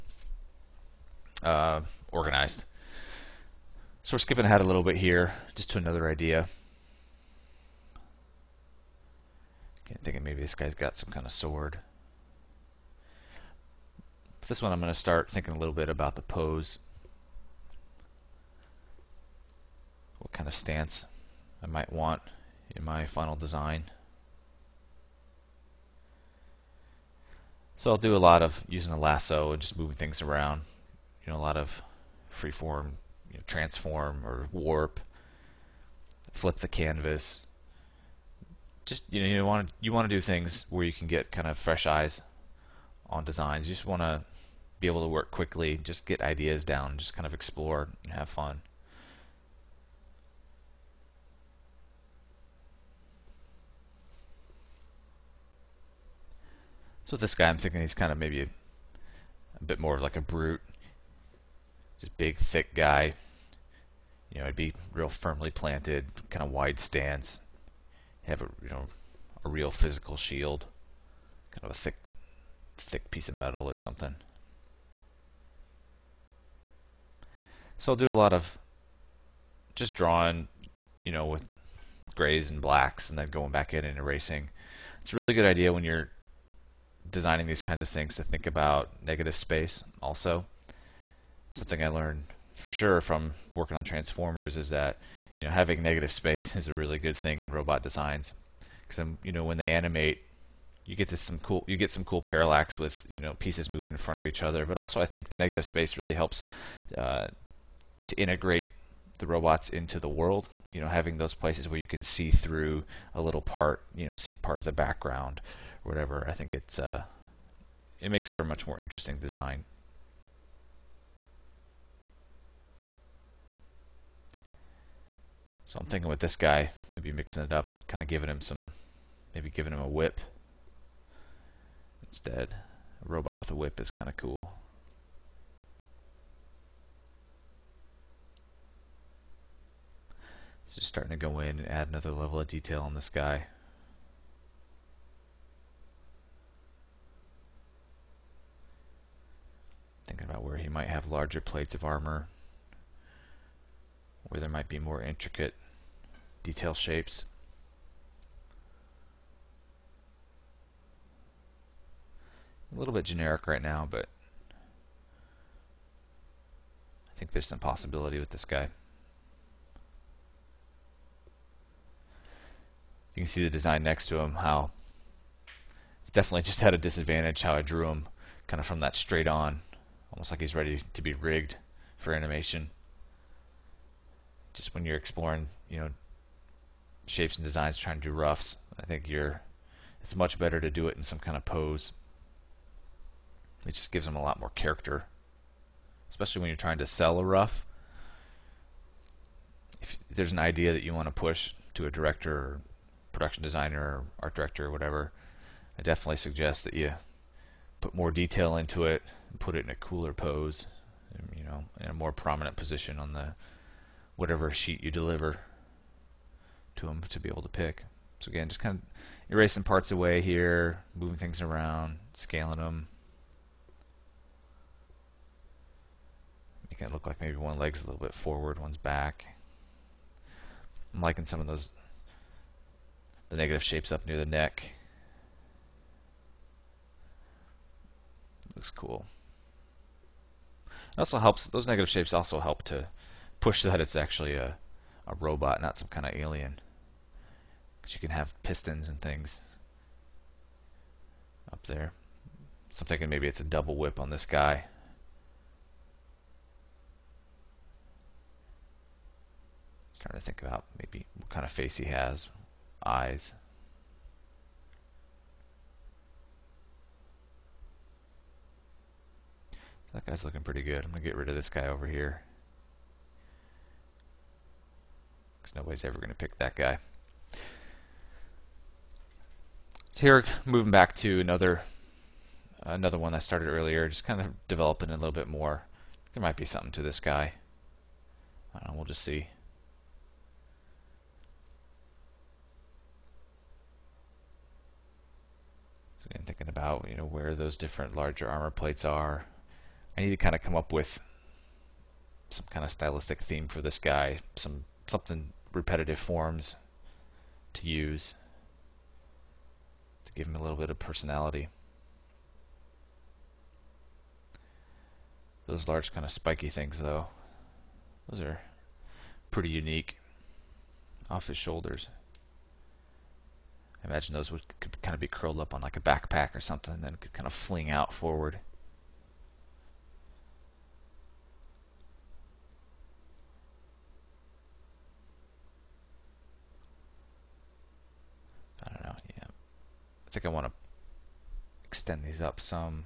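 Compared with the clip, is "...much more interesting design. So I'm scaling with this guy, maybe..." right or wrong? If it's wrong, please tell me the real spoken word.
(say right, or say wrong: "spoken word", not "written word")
wrong: "thinking", not "scaling".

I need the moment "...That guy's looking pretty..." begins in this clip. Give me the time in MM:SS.
04:29.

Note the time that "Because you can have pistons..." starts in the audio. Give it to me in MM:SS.
04:07.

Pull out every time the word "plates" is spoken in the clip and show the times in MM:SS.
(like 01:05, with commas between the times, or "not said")
02:31, 04:58.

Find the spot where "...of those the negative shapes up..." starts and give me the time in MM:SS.
03:51.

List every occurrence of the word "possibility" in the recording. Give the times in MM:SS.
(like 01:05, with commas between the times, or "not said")
02:47.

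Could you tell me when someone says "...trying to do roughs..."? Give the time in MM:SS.
03:07.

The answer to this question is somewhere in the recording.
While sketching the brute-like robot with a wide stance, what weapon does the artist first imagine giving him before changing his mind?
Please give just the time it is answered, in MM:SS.
00:11.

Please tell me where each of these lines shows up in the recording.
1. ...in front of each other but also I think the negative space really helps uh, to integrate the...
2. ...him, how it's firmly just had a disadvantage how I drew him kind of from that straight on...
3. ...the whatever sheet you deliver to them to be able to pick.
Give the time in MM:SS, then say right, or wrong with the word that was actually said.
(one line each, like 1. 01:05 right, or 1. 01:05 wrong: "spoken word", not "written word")
1. 01:43 right
2. 02:54 wrong: "definitely", not "firmly"
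3. 03:33 right.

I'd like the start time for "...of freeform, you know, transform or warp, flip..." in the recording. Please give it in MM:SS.
00:31.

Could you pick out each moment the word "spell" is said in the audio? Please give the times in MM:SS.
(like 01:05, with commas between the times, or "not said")
not said.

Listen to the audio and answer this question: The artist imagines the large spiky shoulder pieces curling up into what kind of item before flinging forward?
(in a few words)
A backpack.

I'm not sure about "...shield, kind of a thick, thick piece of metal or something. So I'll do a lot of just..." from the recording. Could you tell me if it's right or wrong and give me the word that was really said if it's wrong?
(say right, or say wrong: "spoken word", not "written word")
right.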